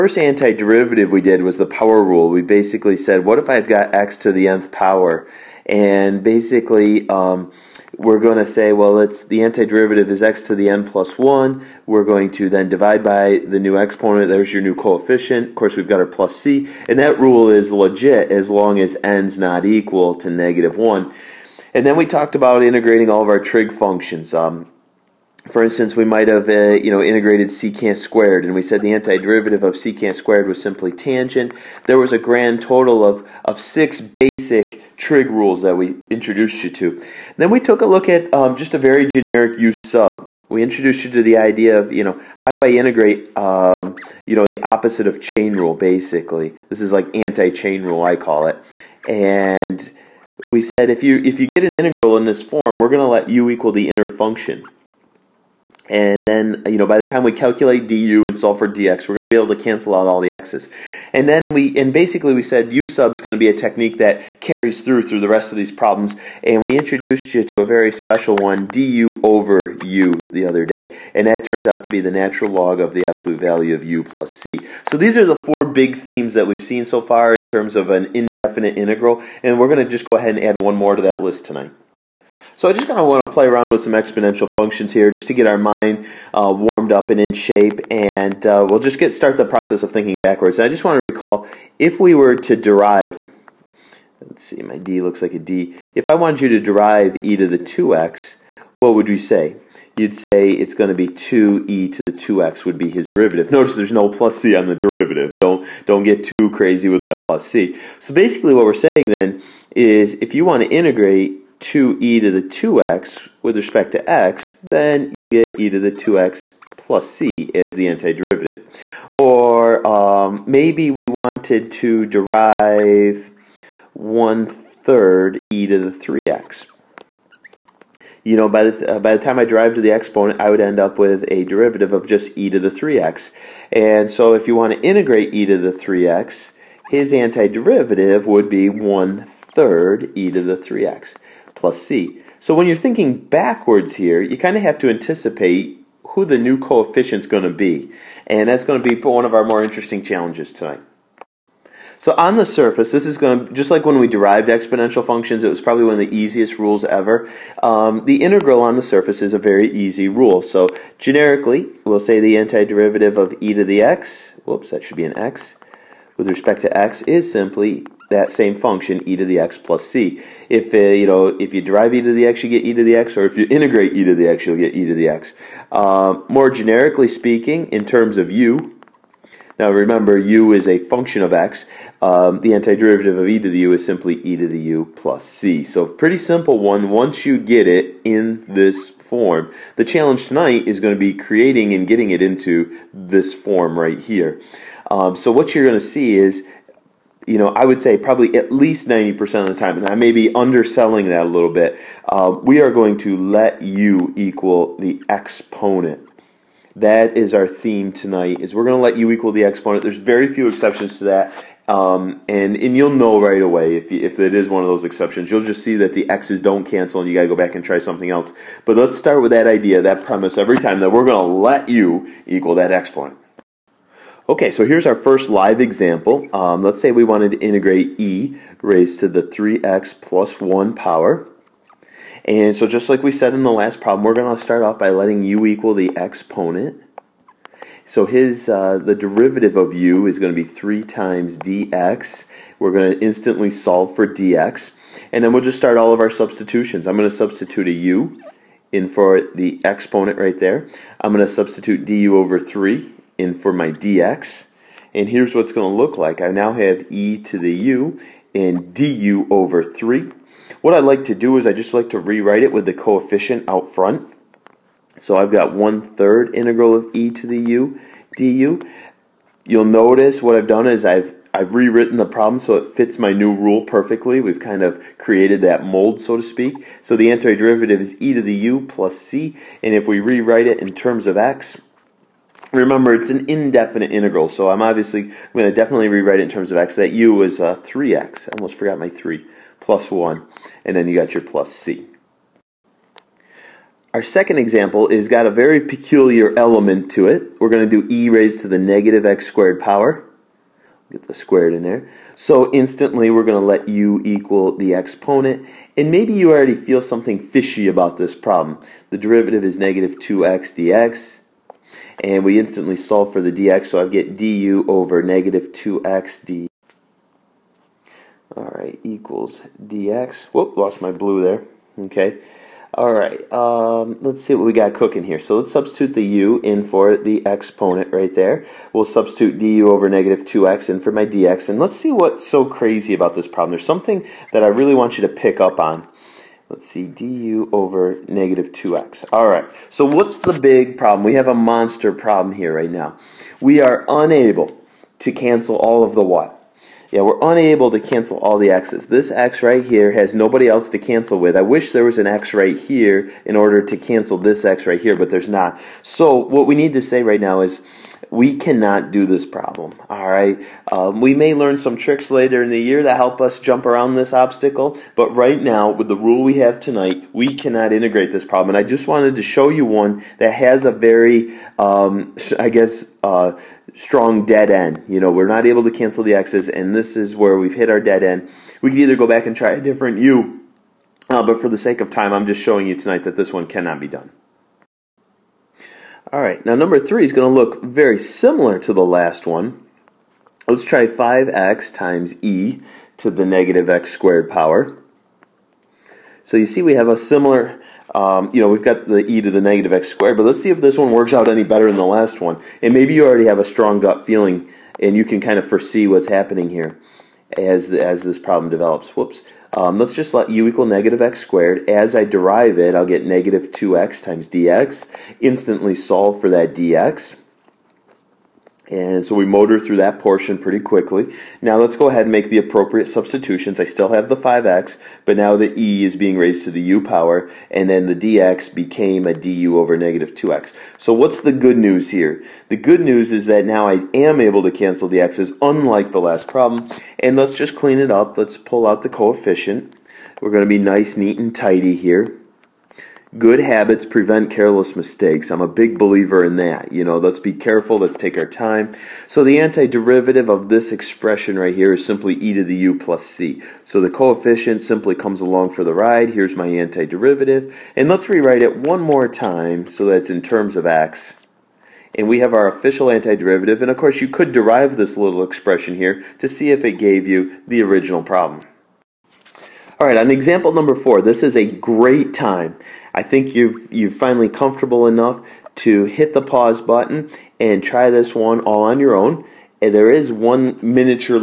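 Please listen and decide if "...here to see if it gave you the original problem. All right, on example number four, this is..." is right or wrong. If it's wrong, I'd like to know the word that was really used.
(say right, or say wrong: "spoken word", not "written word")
right.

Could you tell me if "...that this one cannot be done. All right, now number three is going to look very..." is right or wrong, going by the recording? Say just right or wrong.
right.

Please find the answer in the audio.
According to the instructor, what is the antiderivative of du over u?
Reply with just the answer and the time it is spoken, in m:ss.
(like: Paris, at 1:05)
natural log of the absolute value of u plus c, at 1:12.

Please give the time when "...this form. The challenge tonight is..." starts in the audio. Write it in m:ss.
3:08.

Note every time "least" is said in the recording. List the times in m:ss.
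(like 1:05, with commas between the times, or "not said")
3:18.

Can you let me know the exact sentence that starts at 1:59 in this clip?
Or um, maybe we wanted to derive 1 third e to the 3x.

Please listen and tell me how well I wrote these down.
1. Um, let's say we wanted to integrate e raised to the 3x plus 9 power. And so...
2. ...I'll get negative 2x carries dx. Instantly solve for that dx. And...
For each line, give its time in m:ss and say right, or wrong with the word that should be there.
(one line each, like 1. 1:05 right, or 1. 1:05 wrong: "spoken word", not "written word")
1. 3:46 wrong: "1", not "9"
2. 6:52 wrong: "times", not "carries".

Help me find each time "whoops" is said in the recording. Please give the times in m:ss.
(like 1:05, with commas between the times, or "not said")
2:44, 5:20, 6:48.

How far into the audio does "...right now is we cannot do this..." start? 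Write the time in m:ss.
5:57.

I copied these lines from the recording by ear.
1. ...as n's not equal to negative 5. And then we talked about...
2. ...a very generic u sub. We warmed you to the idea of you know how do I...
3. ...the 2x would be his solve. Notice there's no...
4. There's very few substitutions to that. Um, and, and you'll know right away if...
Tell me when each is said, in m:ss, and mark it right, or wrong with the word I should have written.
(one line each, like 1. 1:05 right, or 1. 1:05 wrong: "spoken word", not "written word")
1. 0:18 wrong: "1", not "5"
2. 0:38 wrong: "introduced", not "warmed"
3. 1:42 wrong: "derivative", not "solve"
4. 3:29 wrong: "exceptions", not "substitutions".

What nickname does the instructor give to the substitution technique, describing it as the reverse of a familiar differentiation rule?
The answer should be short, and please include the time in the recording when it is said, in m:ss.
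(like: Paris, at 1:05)
anti-chain rule, at 0:47.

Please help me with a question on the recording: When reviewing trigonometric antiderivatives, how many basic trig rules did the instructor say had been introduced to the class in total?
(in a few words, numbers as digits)
6.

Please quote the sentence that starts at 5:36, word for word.
Let's see, du over negative 2x.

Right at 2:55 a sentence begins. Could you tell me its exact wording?
Uh, more generically speaking, in terms of u, now remember u is a function of x.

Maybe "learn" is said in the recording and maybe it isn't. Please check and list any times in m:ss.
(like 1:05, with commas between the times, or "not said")
6:01.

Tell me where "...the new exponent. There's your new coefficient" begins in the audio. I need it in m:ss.
0:13.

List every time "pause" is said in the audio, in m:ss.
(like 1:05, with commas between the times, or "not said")
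7:56.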